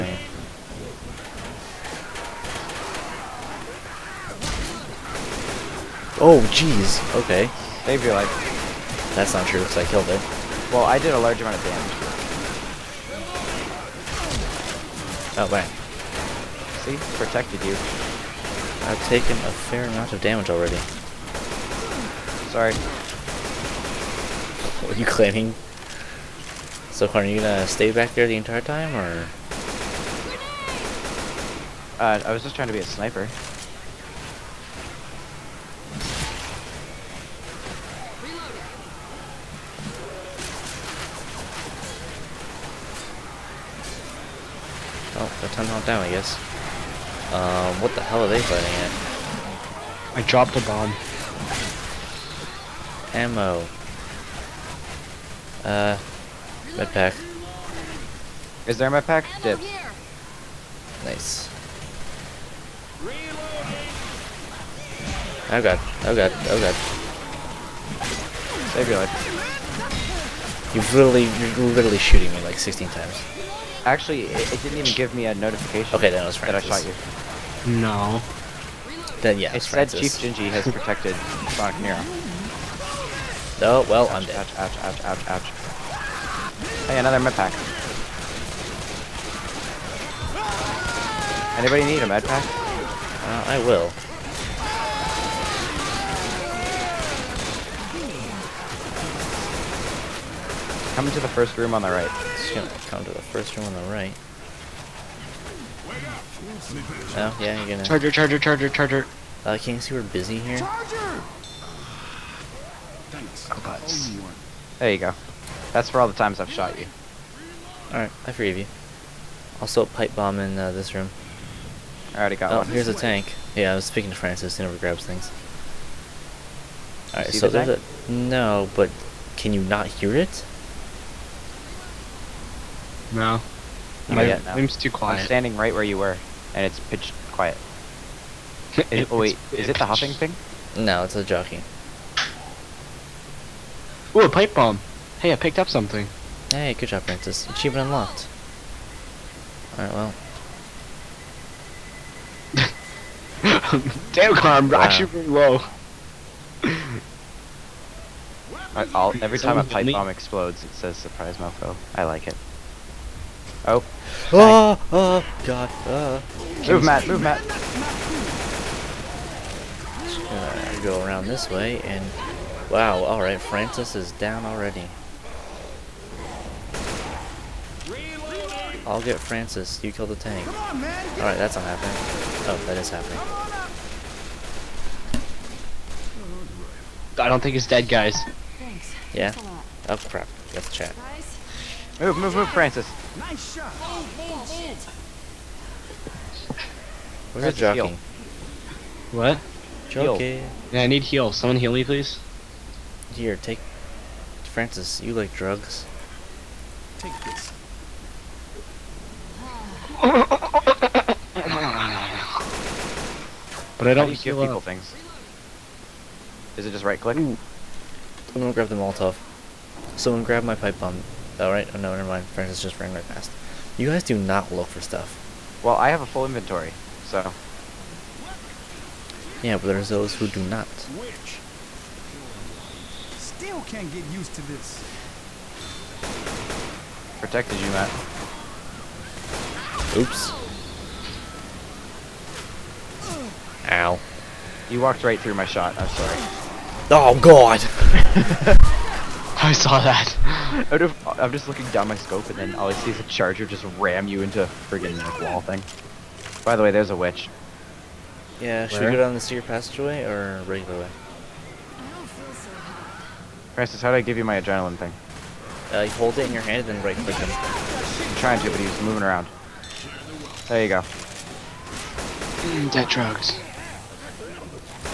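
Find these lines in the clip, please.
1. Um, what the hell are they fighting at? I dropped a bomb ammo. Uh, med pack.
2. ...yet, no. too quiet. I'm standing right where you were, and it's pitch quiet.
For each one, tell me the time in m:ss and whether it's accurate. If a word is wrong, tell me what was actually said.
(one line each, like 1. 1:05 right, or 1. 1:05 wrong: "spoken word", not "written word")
1. 0:47 right
2. 2:14 right.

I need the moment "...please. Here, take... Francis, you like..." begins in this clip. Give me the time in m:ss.
3:21.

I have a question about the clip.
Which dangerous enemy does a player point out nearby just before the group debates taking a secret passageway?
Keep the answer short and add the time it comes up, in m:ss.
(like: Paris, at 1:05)
A witch, at 4:16.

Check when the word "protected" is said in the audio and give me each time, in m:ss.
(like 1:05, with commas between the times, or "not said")
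0:17, 1:20, 3:57.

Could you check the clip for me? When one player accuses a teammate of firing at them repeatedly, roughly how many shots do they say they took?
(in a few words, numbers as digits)
16.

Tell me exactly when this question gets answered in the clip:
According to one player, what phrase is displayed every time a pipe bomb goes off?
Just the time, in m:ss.
2:40.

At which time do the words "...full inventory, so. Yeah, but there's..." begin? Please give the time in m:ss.
3:46.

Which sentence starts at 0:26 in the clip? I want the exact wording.
So, are you gonna stay back there the entire time, or?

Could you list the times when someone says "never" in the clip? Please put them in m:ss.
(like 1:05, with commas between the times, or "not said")
2:04, 3:41.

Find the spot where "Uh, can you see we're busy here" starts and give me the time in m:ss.
1:49.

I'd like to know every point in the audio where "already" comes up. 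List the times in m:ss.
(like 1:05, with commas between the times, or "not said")
0:20, 2:02, 2:54.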